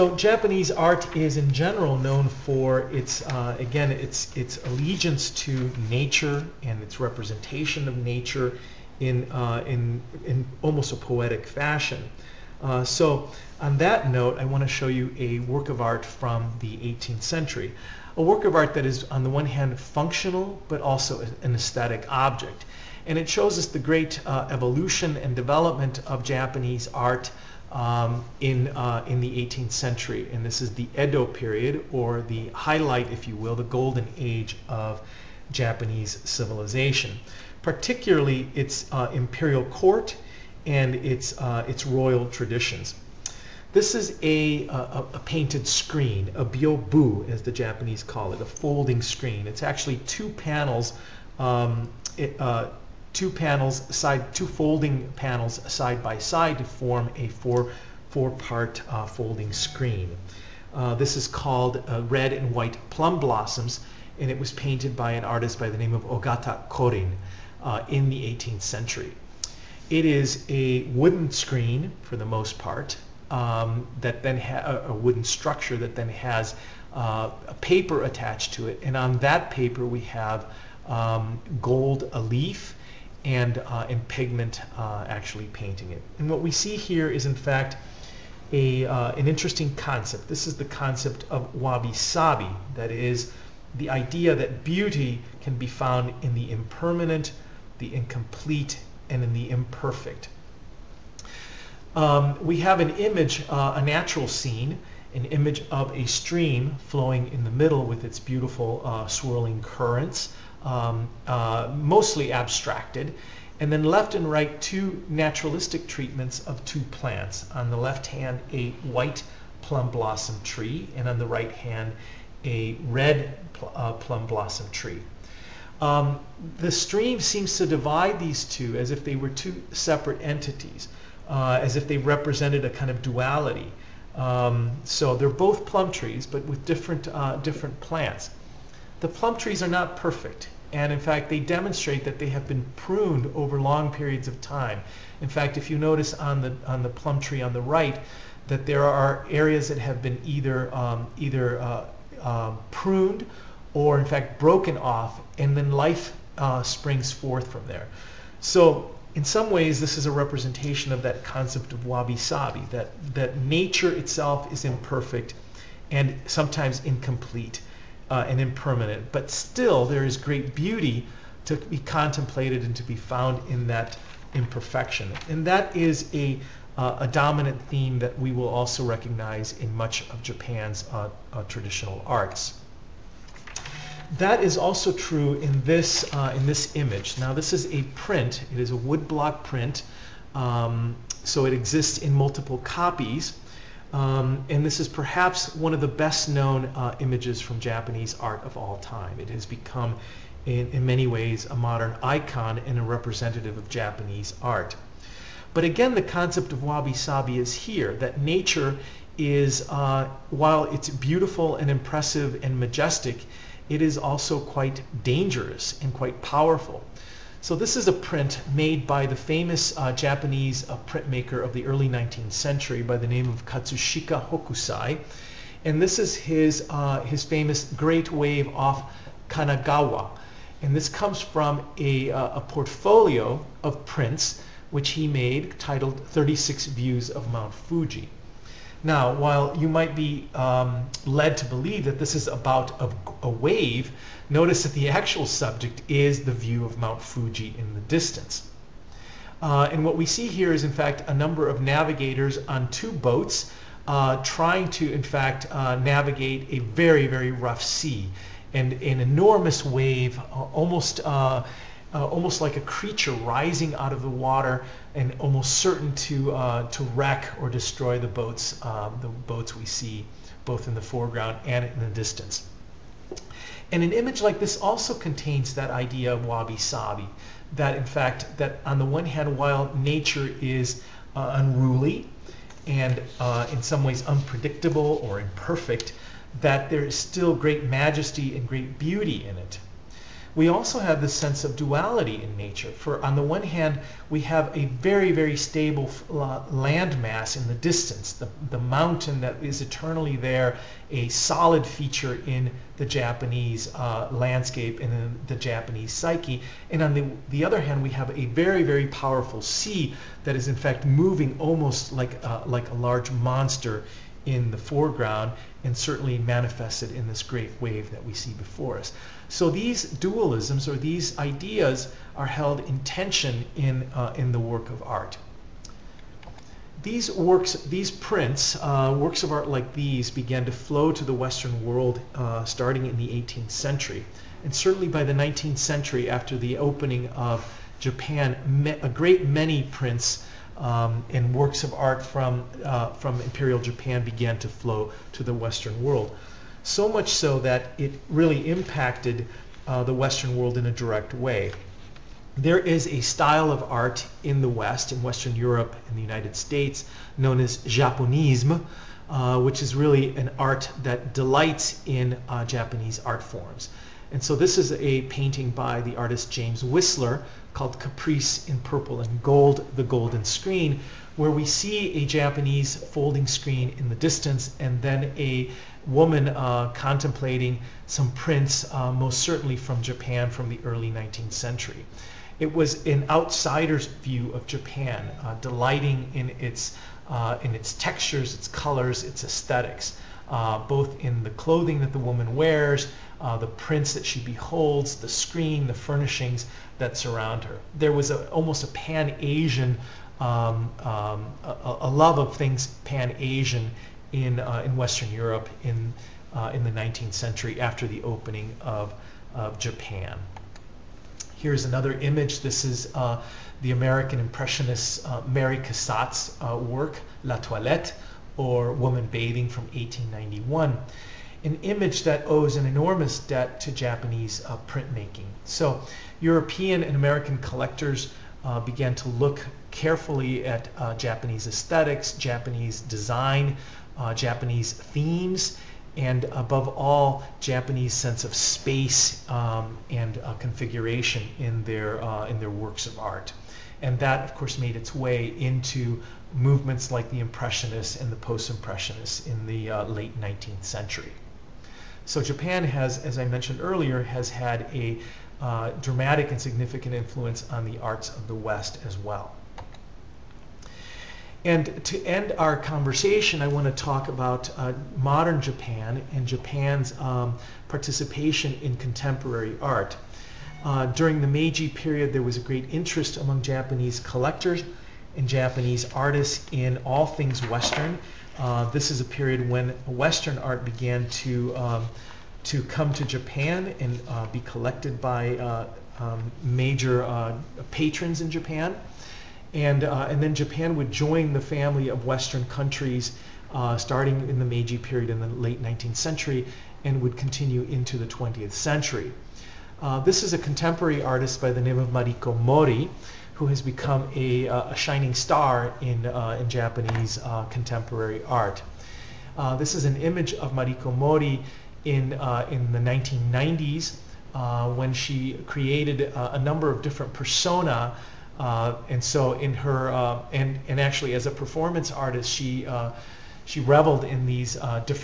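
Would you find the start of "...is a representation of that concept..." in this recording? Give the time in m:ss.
2:39.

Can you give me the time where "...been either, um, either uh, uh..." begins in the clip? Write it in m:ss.
2:30.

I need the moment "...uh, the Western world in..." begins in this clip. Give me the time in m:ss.
5:49.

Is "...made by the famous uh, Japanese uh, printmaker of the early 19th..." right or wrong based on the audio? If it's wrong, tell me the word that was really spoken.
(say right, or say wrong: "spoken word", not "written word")
right.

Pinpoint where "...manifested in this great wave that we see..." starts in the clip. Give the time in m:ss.
5:16.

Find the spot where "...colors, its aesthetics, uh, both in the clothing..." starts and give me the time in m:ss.
6:28.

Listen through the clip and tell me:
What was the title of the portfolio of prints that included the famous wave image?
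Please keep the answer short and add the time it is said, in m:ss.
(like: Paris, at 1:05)
36 Views of Mount Fuji, at 3:56.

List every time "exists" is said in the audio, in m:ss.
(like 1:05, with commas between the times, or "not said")
3:11.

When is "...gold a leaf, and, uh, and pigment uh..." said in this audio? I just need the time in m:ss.
1:21.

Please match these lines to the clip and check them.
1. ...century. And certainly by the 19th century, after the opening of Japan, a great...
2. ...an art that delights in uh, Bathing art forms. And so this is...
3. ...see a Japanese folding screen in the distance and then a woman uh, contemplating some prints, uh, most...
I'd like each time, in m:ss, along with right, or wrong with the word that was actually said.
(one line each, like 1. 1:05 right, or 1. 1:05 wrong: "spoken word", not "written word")
1. 5:33 right
2. 6:00 wrong: "Japanese", not "Bathing"
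3. 6:11 right.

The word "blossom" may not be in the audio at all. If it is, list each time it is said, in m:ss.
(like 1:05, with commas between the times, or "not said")
1:03, 1:59, 2:04.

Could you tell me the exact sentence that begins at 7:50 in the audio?
Uh, during the Meiji period, there was a great interest among Japanese collectors and Japanese artists in all things Western.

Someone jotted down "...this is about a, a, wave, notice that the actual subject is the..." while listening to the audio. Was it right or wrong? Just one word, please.
right.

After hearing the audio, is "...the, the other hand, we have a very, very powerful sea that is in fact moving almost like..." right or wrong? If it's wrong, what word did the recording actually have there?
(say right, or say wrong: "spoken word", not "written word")
right.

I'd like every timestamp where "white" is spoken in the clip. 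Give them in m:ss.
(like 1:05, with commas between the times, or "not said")
1:02, 1:58.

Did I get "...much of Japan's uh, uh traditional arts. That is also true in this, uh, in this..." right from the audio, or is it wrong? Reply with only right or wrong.
right.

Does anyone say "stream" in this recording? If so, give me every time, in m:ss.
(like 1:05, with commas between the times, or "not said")
1:46, 2:06.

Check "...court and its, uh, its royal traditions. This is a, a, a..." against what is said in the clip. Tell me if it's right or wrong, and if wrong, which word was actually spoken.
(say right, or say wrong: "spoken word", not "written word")
right.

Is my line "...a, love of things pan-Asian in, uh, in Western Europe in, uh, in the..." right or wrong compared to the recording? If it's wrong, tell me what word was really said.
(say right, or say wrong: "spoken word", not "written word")
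right.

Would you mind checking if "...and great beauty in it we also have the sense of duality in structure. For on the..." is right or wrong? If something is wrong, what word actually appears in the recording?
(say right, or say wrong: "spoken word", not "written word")
wrong: "nature", not "structure".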